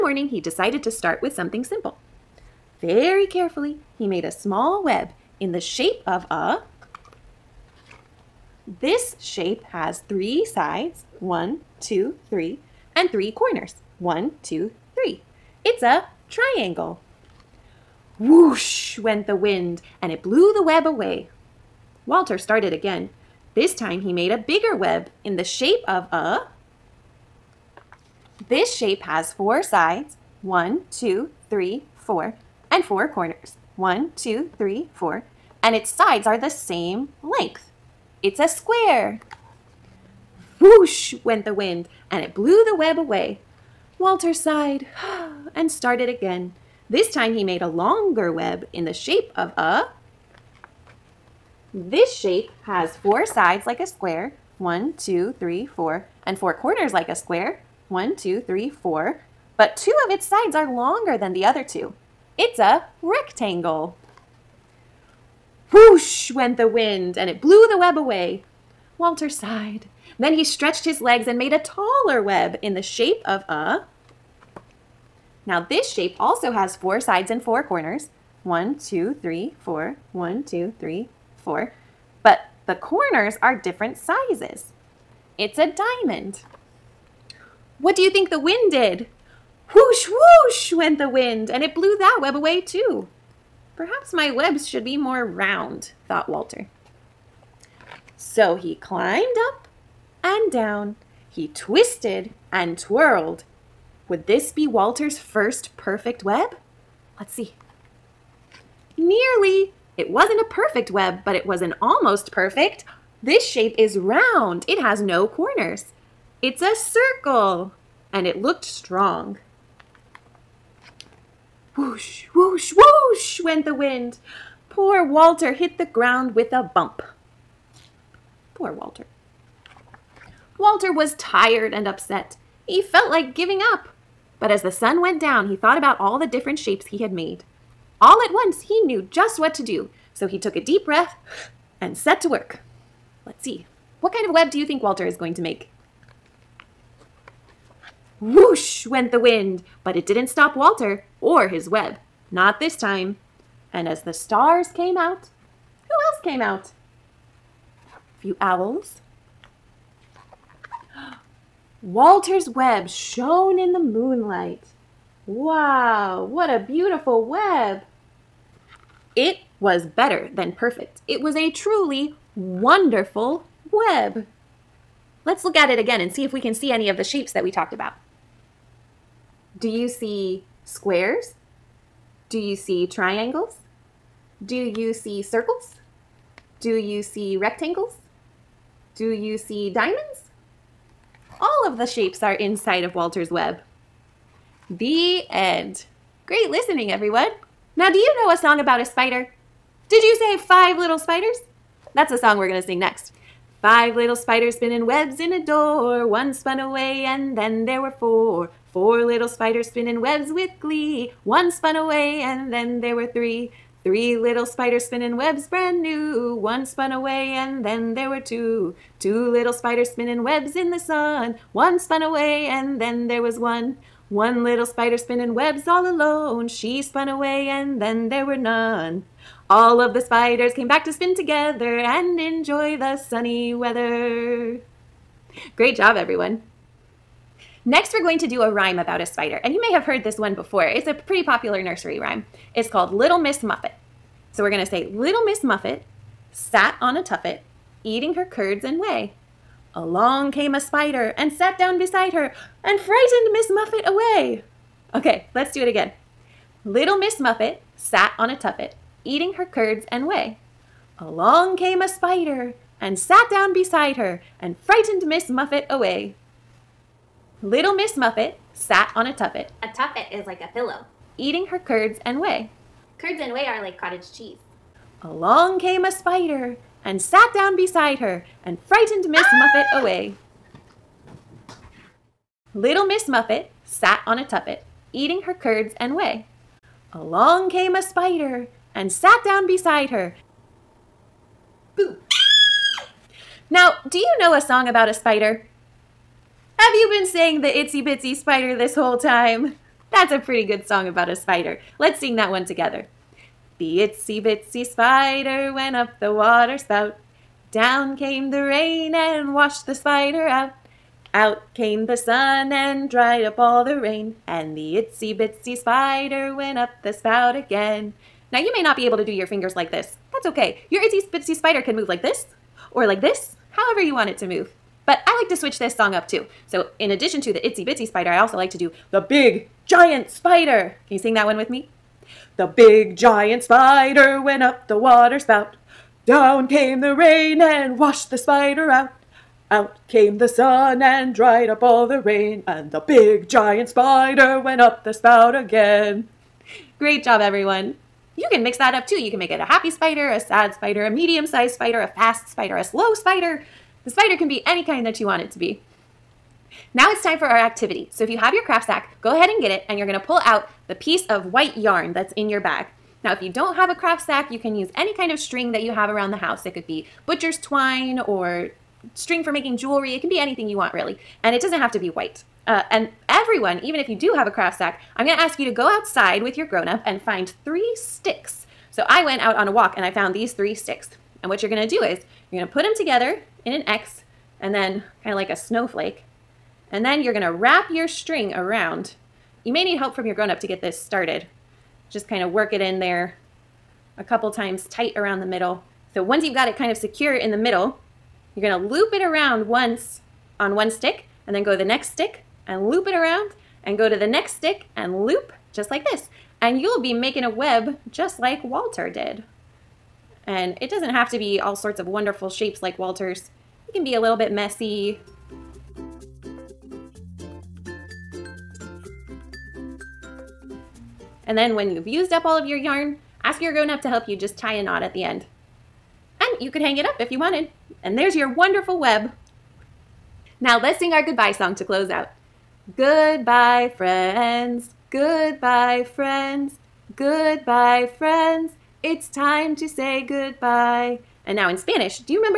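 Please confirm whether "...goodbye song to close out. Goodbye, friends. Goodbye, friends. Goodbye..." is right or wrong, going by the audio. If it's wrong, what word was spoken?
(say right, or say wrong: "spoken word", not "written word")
right.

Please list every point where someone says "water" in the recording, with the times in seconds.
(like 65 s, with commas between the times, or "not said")
306 s, 334 s.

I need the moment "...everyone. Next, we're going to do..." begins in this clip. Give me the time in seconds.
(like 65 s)
235 s.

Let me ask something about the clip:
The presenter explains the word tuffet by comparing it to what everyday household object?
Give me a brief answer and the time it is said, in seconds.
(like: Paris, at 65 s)
a pillow, at 270 s.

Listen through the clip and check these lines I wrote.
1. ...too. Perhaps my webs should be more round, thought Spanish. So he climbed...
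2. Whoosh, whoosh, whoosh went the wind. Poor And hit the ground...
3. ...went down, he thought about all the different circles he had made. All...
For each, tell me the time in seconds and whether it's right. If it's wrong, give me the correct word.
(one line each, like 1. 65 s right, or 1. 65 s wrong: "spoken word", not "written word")
1. 92 s wrong: "Walter", not "Spanish"
2. 121 s wrong: "Walter", not "And"
3. 135 s wrong: "shapes", not "circles".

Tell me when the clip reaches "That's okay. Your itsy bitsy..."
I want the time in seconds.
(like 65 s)
320 s.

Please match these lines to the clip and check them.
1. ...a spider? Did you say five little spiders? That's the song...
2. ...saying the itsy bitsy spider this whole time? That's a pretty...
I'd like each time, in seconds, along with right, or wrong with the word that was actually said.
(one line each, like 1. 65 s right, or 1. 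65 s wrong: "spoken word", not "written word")
1. 198 s right
2. 297 s right.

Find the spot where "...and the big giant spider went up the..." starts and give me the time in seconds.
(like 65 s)
342 s.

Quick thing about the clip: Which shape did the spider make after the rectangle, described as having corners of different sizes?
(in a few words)
diamond.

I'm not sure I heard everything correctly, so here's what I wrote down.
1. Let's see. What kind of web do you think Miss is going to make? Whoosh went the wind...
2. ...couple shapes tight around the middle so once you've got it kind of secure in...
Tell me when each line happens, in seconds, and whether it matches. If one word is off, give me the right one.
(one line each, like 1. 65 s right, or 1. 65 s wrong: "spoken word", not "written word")
1. 143 s wrong: "Walter", not "Miss"
2. 394 s wrong: "times", not "shapes".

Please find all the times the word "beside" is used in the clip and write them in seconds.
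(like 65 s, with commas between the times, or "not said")
251 s, 263 s, 277 s, 289 s.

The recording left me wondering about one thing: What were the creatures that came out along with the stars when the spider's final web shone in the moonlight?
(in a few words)
owls.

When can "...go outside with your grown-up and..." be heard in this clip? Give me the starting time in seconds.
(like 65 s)
375 s.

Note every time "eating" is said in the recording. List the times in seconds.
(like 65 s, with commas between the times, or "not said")
247 s, 259 s, 271 s, 284 s.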